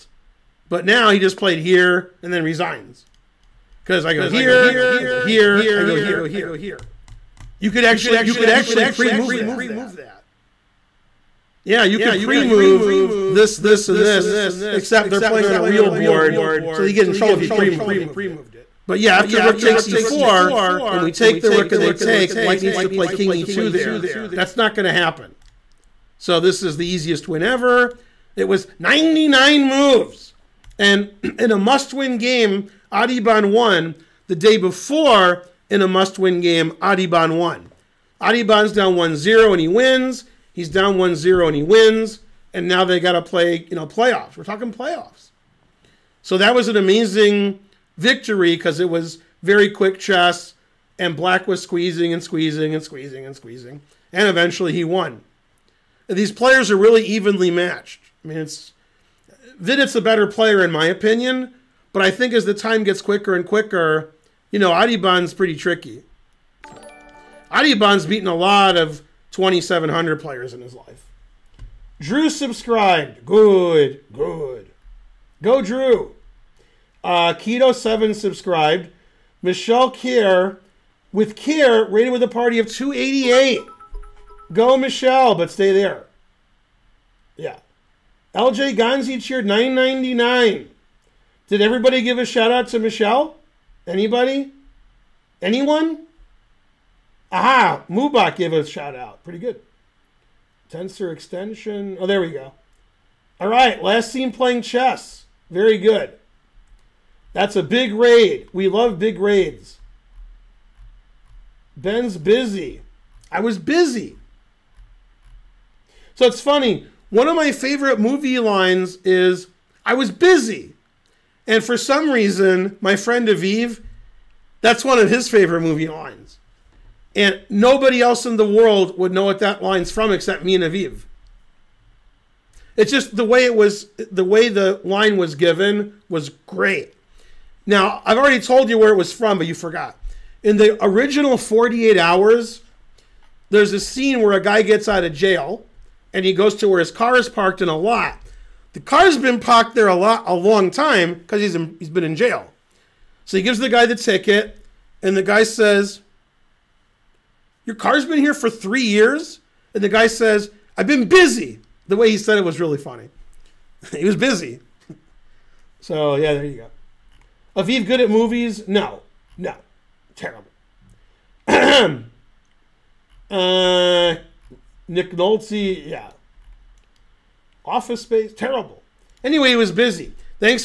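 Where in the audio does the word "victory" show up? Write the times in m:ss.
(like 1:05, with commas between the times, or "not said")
0:47.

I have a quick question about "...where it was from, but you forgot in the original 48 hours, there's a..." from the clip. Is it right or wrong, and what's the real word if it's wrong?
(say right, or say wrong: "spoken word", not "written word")
right.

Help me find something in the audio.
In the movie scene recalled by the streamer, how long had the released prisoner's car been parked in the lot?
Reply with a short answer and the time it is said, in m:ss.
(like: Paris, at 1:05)
3 years, at 2:38.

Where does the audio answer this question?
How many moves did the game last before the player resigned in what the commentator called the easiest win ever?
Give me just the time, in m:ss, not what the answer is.
0:28.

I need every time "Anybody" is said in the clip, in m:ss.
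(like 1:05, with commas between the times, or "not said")
1:33.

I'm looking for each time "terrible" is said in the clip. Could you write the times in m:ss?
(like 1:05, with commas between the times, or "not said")
2:50, 2:58.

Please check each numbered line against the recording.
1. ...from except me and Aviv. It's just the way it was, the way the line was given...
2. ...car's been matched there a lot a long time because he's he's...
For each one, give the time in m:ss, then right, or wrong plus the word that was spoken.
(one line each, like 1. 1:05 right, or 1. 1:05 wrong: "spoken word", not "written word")
1. 2:09 right
2. 2:28 wrong: "parked", not "matched".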